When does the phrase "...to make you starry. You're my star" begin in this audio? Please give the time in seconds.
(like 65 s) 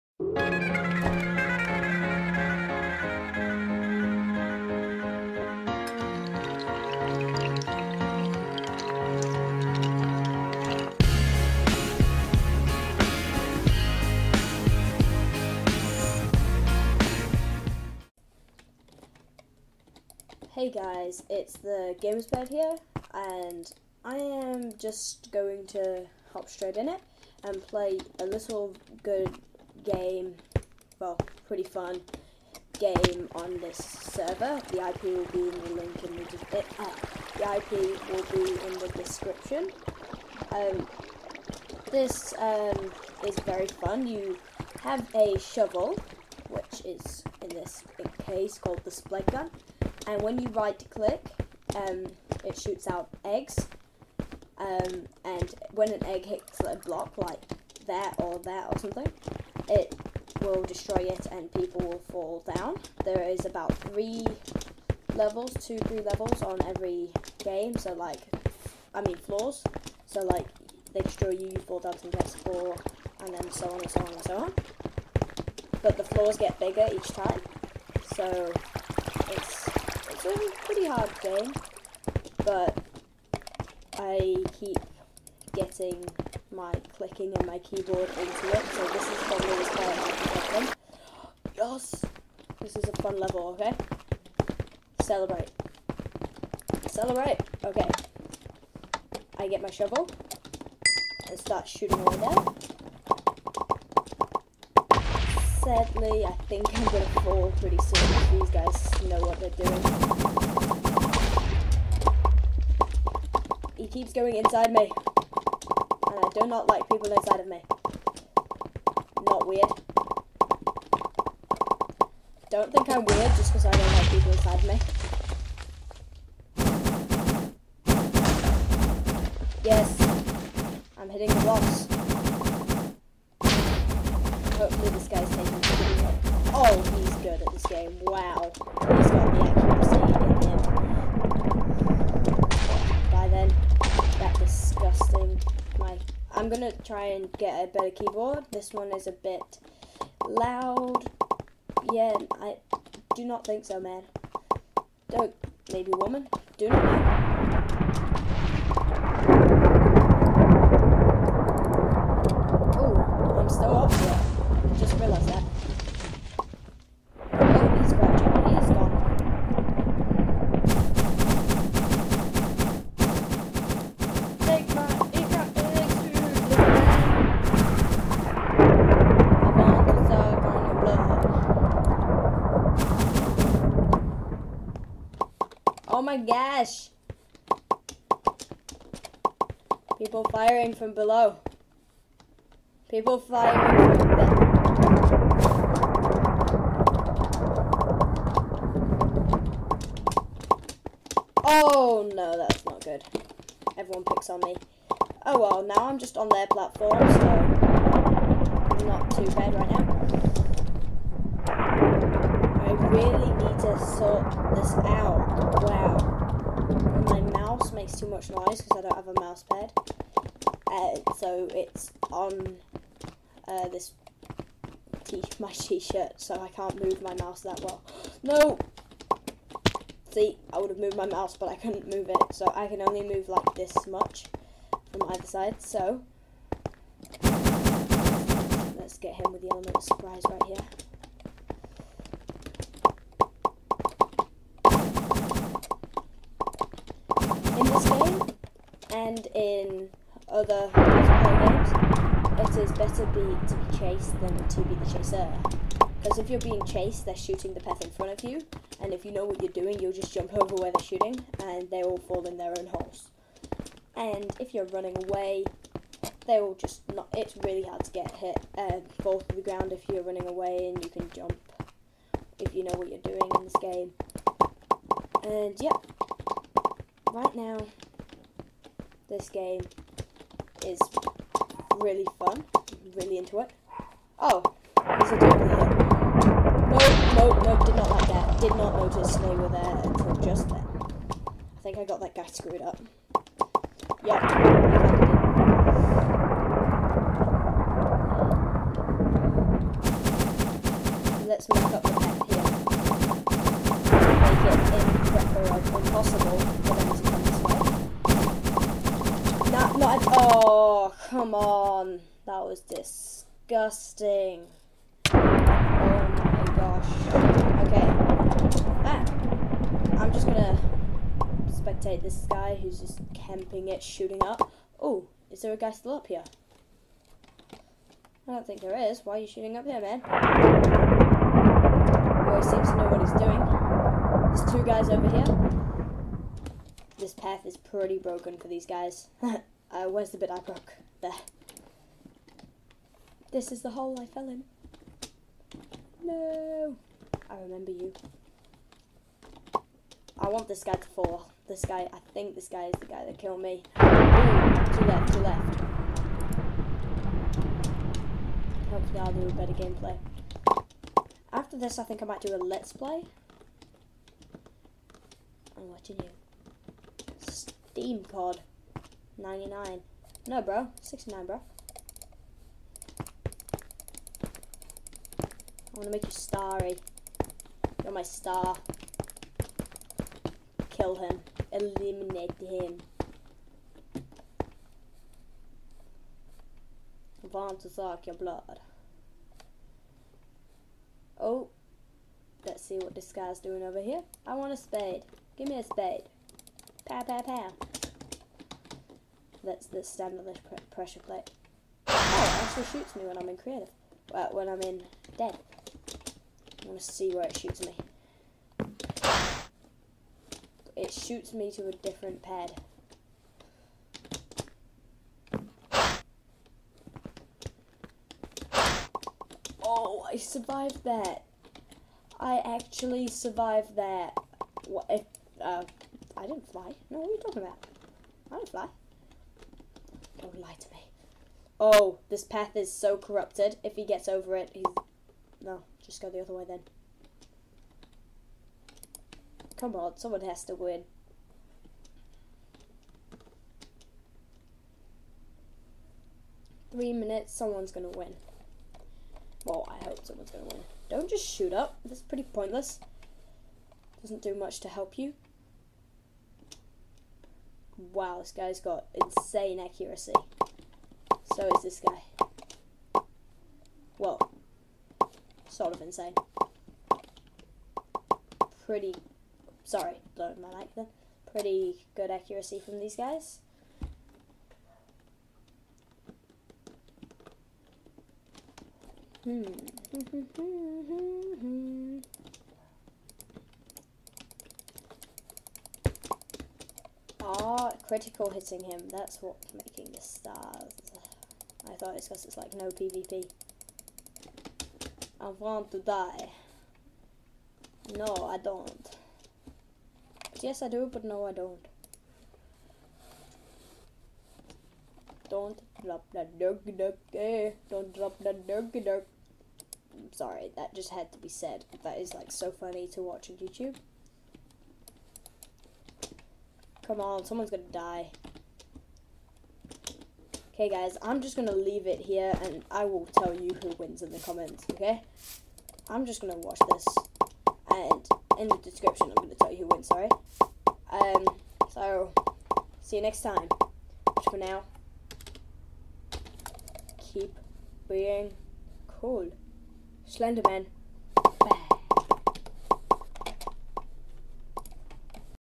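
375 s.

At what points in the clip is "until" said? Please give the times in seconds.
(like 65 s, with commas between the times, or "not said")
289 s.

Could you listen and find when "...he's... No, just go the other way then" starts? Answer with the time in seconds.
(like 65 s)
434 s.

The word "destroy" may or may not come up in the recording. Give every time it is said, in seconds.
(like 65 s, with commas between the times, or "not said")
60 s, 71 s.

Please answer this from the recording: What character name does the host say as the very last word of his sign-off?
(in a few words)
Slenderman.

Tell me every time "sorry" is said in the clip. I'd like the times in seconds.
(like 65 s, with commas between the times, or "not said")
469 s, 510 s, 529 s.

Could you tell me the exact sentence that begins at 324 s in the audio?
Oh, is there a guy still up here?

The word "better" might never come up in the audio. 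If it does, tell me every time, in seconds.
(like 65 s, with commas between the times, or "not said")
147 s, 252 s, 359 s.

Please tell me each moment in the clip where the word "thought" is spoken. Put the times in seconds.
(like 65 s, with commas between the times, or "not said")
491 s.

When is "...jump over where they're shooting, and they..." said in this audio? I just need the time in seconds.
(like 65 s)
260 s.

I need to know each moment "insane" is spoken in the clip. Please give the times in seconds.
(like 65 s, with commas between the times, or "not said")
458 s, 465 s.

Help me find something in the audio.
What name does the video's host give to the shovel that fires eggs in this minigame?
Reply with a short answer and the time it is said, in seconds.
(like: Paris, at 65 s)
Splegg gun, at 48 s.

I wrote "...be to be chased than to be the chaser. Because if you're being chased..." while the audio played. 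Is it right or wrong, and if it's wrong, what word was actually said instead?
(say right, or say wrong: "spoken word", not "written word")
right.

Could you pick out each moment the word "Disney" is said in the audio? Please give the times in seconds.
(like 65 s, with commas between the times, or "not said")
not said.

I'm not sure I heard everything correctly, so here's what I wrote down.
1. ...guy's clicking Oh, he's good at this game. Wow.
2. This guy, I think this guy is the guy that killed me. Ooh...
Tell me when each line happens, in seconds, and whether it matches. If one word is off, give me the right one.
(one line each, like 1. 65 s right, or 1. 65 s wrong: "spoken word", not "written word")
1. 135 s wrong: "taking", not "clicking"
2. 351 s right.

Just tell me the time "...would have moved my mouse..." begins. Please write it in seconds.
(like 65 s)
230 s.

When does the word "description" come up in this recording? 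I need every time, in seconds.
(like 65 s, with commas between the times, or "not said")
38 s, 528 s.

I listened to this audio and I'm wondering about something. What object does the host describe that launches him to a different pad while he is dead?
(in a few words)
Pressure plate.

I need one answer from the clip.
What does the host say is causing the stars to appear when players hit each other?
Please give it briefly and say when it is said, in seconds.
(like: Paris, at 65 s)
Critical hitting, at 487 s.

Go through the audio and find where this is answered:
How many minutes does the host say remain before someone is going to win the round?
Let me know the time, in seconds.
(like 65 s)
446 s.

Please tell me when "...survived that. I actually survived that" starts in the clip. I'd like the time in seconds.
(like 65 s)
420 s.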